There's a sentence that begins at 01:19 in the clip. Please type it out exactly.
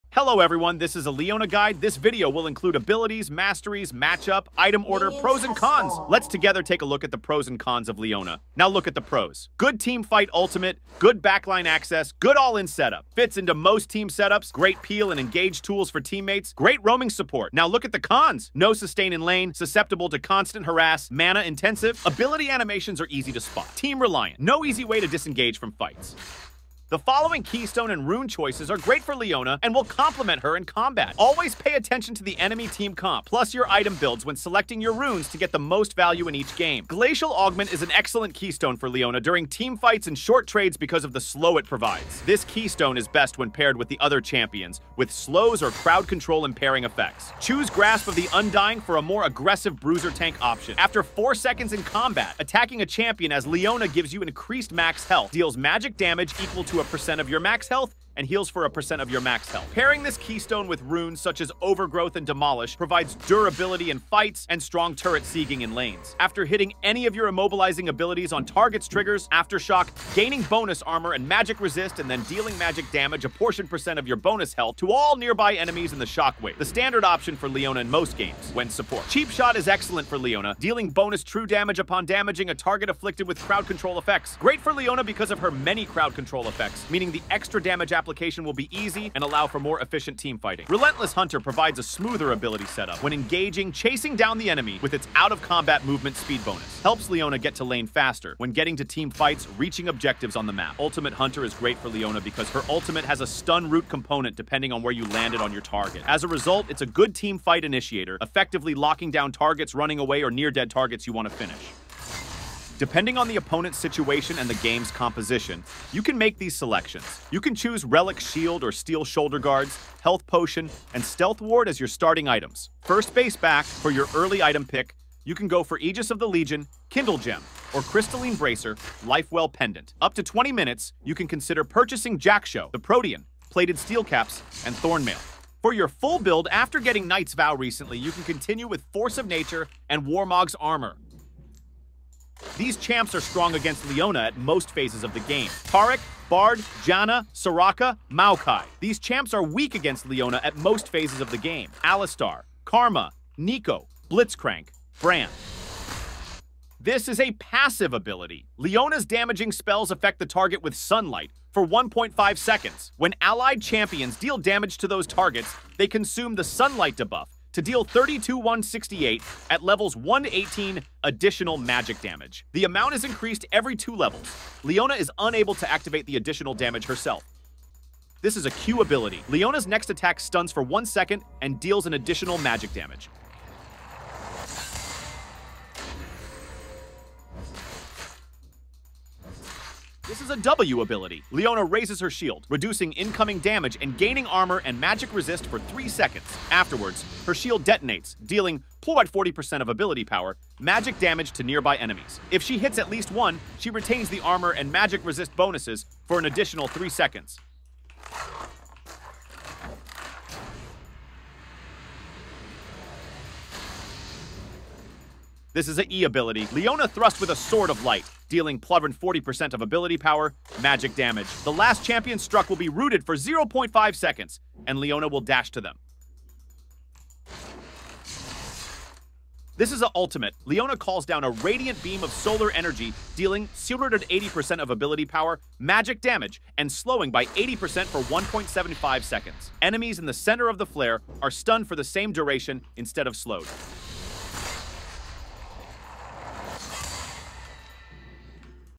Cheap Shot is excellent for Leona, dealing bonus true damage upon damaging a target afflicted with crowd control effects.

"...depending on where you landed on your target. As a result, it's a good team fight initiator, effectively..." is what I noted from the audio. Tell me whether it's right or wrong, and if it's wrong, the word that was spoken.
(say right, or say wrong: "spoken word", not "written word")
right.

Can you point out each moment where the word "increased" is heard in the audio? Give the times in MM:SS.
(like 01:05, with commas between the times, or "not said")
00:54, 02:53.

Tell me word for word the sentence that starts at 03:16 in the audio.
Afterwards, her shield detonates, dealing plus 40% of ability power, magic damage to nearby enemies.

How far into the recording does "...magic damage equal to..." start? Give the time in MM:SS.
00:55.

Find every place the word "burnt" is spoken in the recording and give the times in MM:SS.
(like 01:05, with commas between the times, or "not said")
not said.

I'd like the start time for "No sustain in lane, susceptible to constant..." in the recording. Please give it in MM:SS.
00:18.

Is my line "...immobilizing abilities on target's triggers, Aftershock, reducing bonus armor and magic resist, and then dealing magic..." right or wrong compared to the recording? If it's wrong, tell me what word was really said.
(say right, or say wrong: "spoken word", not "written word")
wrong: "gaining", not "reducing".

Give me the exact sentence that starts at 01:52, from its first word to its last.
Depending on the opponent's situation and the game's composition, you can make these selections.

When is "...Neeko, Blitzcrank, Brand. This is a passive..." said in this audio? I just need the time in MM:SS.
02:33.